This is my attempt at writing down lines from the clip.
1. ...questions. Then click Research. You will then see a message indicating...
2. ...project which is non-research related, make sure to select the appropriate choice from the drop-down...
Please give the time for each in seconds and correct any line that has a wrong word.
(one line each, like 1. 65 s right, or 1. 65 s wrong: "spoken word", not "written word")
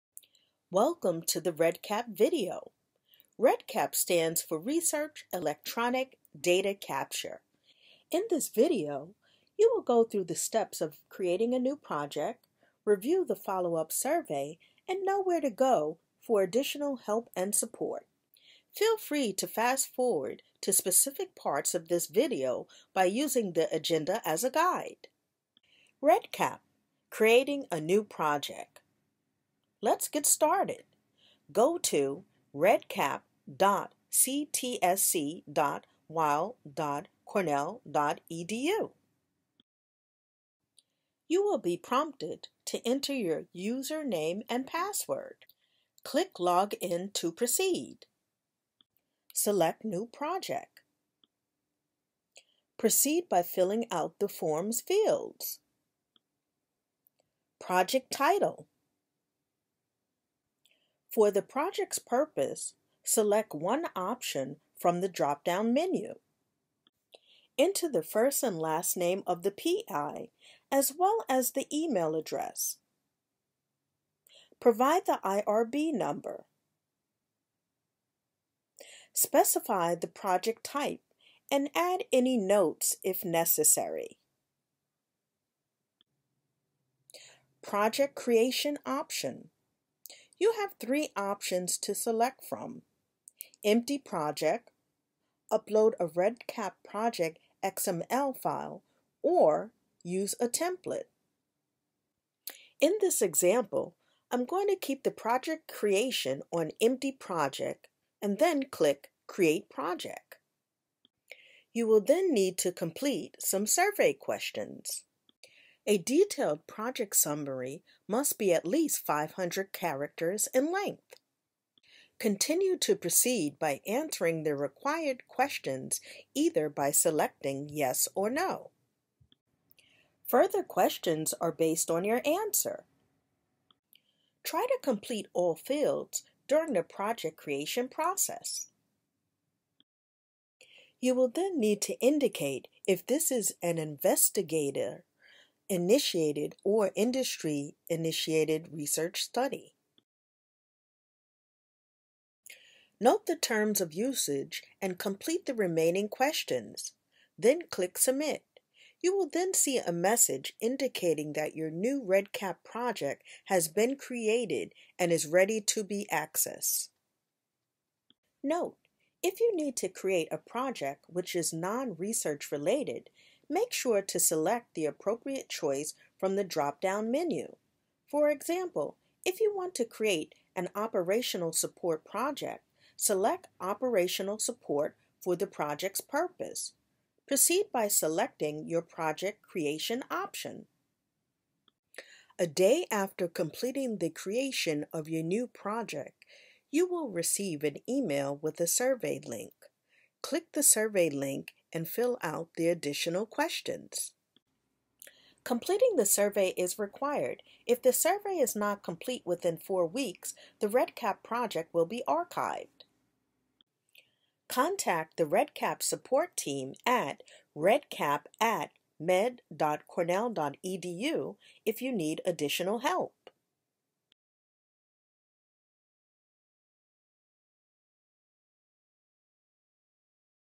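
1. 156 s wrong: "Submit", not "Research"
2. 170 s right.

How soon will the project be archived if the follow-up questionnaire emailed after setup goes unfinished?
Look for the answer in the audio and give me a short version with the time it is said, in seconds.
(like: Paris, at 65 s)
4 weeks, at 209 s.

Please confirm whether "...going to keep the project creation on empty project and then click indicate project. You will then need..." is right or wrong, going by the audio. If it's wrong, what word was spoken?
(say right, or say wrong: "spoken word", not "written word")
wrong: "create", not "indicate".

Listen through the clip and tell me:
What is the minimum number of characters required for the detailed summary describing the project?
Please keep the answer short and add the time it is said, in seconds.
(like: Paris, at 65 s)
500, at 119 s.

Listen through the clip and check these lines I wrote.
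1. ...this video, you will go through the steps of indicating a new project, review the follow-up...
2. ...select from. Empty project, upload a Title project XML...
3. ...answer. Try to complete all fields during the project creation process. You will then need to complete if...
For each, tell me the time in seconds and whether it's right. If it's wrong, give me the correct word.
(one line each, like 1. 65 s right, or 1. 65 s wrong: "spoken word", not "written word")
1. 8 s wrong: "creating", not "indicating"
2. 91 s wrong: "REDCap", not "Title"
3. 132 s wrong: "indicate", not "complete".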